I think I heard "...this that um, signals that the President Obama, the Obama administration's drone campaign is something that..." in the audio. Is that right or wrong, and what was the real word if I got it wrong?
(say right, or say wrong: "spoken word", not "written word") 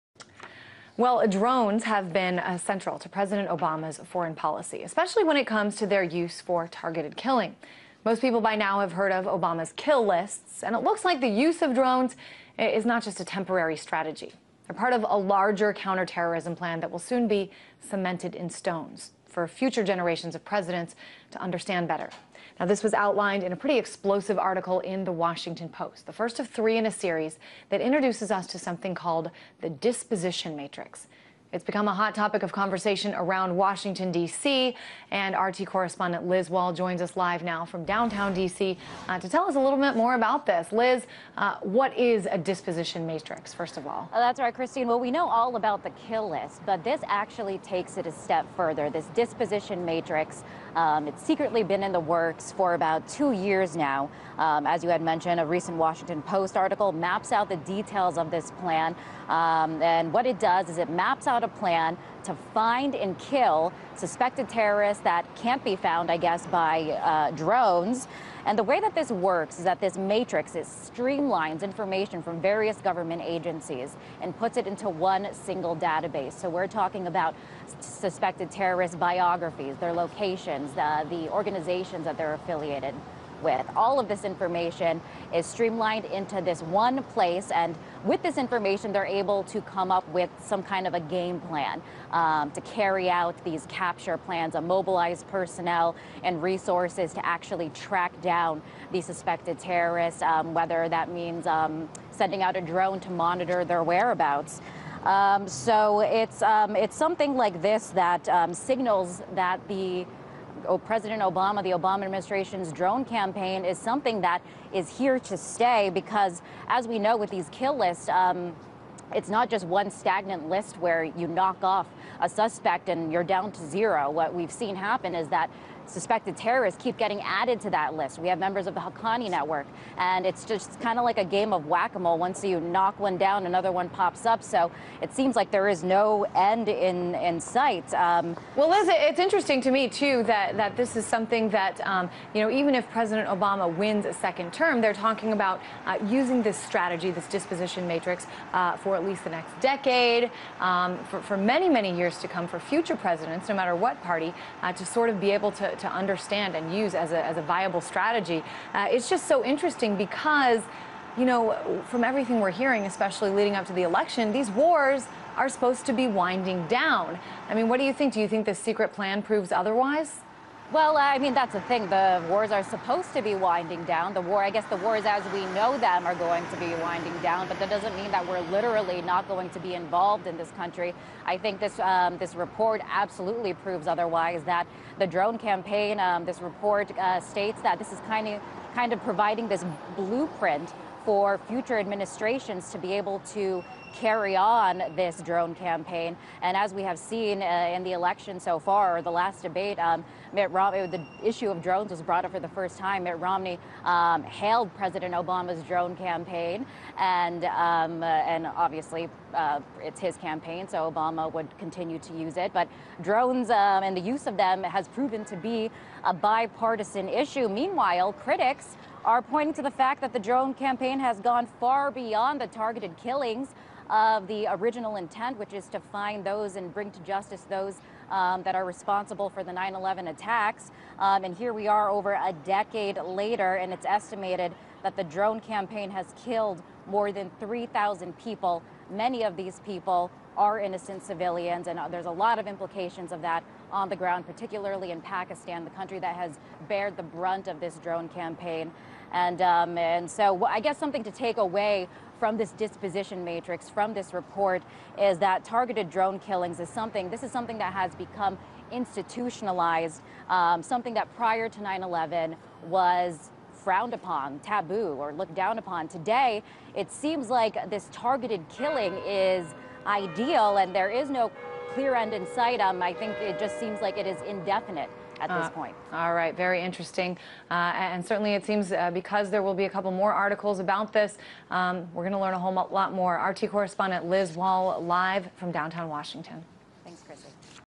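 right.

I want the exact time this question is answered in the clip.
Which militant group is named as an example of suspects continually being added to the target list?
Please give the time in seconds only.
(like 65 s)
128 s.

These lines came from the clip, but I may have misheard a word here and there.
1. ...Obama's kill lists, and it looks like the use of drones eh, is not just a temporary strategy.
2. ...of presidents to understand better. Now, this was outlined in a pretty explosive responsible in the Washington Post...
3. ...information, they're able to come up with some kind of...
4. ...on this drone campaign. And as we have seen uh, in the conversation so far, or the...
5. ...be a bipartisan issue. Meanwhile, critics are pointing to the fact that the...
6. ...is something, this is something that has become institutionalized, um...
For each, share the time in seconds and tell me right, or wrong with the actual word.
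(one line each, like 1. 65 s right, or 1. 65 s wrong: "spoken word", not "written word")
1. 9 s right
2. 20 s wrong: "article", not "responsible"
3. 88 s right
4. 194 s wrong: "election", not "conversation"
5. 215 s right
6. 256 s right.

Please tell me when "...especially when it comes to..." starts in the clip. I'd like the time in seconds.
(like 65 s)
4 s.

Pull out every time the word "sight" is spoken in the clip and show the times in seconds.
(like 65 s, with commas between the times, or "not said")
137 s, 272 s.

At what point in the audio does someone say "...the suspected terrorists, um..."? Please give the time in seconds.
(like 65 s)
98 s.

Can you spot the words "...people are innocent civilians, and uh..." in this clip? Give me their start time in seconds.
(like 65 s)
239 s.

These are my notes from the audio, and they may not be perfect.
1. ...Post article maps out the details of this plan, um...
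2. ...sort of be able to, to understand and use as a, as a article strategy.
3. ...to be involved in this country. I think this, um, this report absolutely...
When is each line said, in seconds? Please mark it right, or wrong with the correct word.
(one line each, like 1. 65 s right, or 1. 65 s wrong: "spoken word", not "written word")
1. 56 s right
2. 154 s wrong: "viable", not "article"
3. 179 s right.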